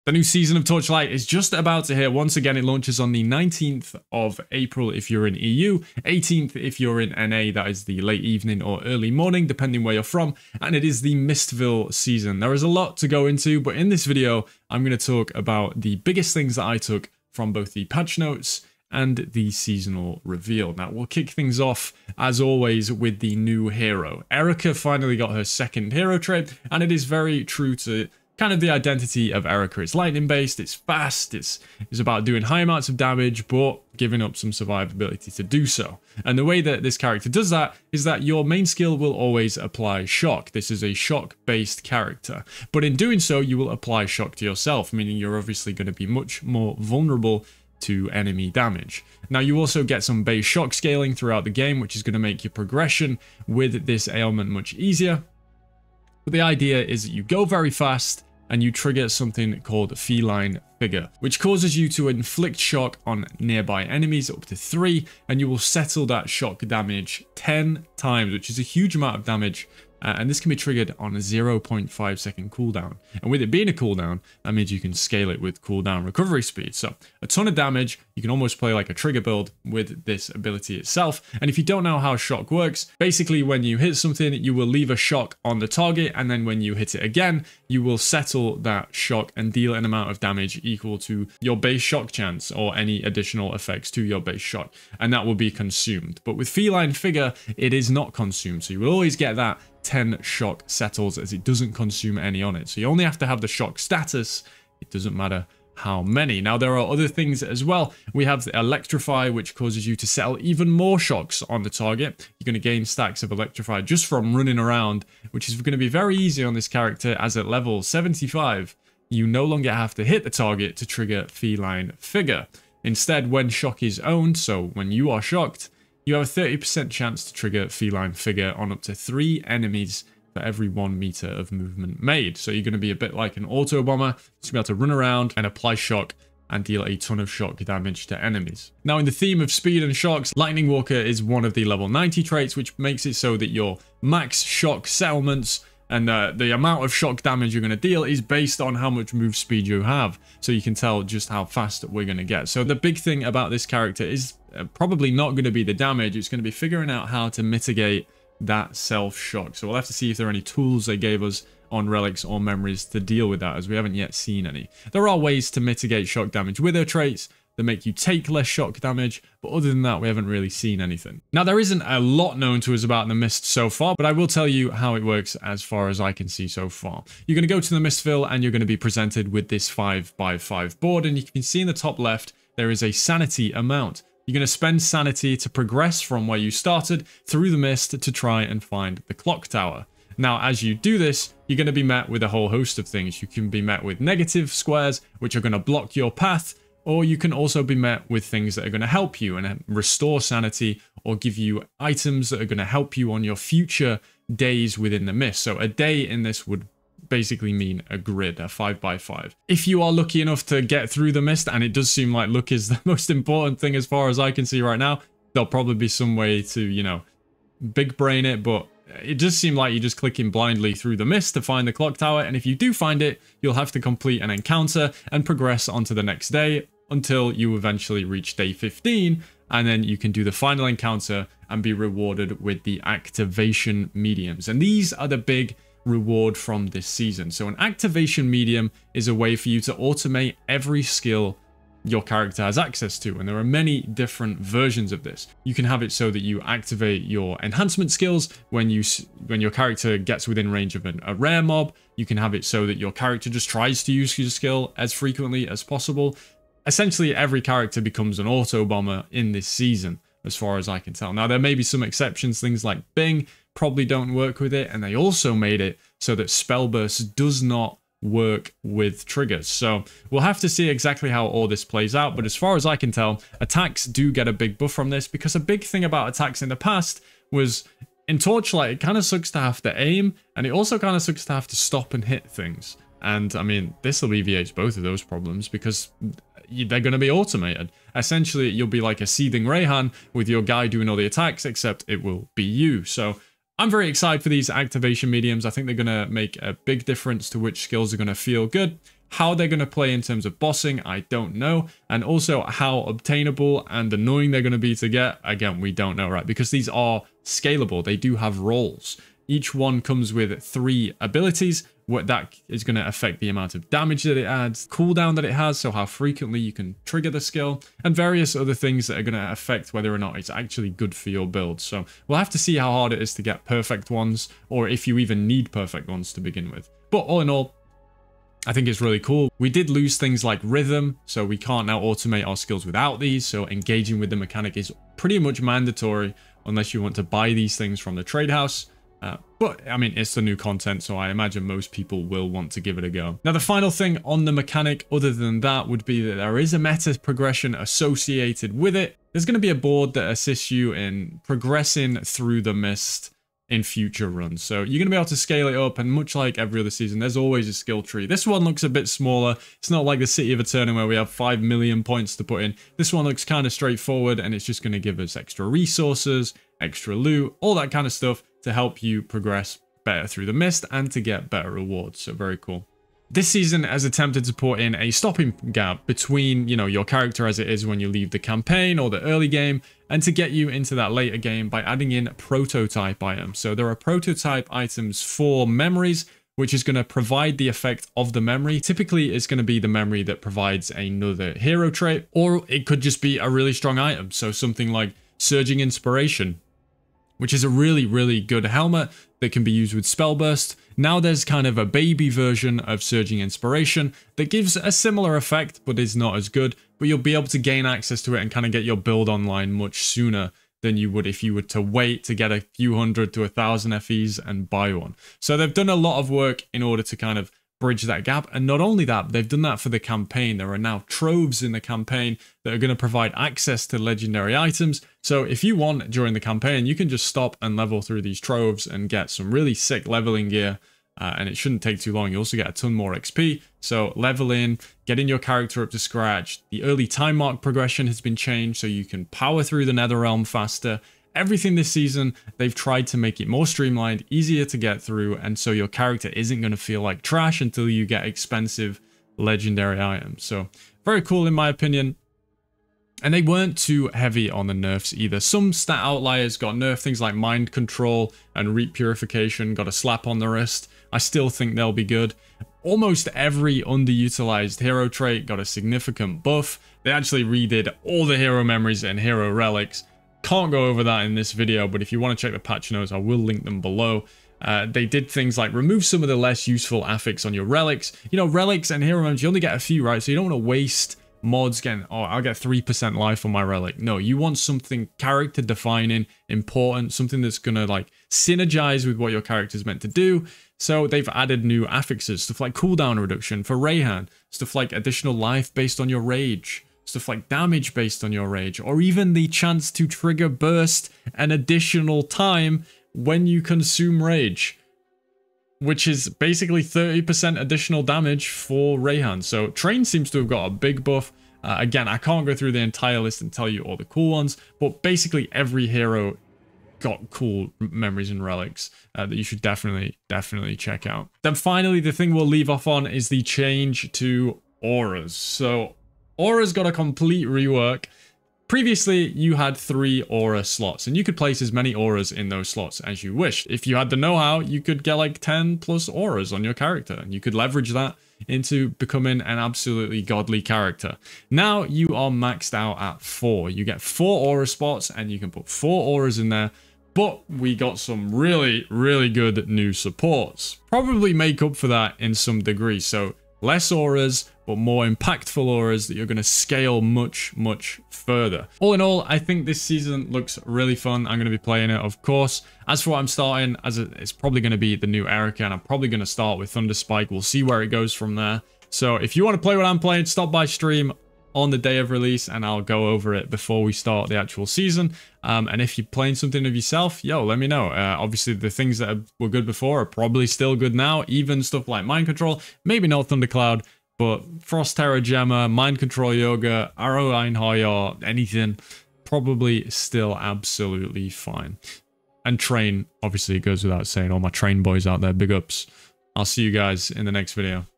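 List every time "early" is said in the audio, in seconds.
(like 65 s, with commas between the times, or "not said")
8 s, 379 s, 436 s.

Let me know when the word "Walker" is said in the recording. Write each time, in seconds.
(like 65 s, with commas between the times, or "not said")
140 s.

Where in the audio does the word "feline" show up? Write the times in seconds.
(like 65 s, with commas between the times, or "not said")
59 s, 96 s, 121 s, 127 s.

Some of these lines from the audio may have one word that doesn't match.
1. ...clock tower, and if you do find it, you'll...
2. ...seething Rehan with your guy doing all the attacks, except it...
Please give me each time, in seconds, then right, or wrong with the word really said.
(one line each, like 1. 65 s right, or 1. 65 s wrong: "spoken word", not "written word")
1. 221 s right
2. 289 s right.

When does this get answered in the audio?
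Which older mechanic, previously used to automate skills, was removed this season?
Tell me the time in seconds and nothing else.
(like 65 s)
330 s.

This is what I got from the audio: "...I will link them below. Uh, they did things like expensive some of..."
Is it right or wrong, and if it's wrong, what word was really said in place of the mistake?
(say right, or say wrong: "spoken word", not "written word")
wrong: "remove", not "expensive".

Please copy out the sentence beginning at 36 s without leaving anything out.
And the way that this character does that is that your main skill will always apply shock.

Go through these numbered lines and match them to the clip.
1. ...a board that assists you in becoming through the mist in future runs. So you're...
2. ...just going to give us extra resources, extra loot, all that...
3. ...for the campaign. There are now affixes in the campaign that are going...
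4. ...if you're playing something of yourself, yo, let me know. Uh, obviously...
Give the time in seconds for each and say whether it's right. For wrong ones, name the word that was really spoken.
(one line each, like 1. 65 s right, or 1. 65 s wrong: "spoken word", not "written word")
1. 349 s wrong: "progressing", not "becoming"
2. 364 s right
3. 419 s wrong: "troves", not "affixes"
4. 575 s right.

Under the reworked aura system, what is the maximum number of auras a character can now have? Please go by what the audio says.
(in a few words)
4.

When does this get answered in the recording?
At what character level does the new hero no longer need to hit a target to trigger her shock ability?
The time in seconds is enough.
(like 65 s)
117 s.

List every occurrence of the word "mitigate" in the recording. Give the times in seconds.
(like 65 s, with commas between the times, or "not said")
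157 s, 165 s.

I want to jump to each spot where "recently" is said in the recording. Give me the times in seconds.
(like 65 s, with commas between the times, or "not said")
not said.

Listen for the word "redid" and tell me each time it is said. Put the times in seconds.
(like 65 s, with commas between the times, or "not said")
467 s.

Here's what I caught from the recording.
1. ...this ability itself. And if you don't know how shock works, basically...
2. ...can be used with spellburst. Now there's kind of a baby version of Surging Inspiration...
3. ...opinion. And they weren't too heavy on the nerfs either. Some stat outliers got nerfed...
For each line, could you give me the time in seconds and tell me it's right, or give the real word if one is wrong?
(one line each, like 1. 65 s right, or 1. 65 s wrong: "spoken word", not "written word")
1. 80 s right
2. 399 s right
3. 451 s right.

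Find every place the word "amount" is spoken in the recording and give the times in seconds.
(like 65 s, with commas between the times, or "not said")
32 s, 68 s, 89 s, 146 s, 183 s, 313 s.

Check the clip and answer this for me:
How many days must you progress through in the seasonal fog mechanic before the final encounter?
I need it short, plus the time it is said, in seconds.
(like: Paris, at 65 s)
15, at 228 s.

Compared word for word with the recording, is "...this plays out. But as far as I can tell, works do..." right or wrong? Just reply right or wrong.
wrong.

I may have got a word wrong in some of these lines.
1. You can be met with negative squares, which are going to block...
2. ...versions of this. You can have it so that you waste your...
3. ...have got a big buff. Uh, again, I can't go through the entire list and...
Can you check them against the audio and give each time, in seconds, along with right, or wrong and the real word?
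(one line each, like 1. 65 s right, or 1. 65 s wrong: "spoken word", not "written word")
1. 193 s right
2. 244 s wrong: "activate", not "waste"
3. 510 s right.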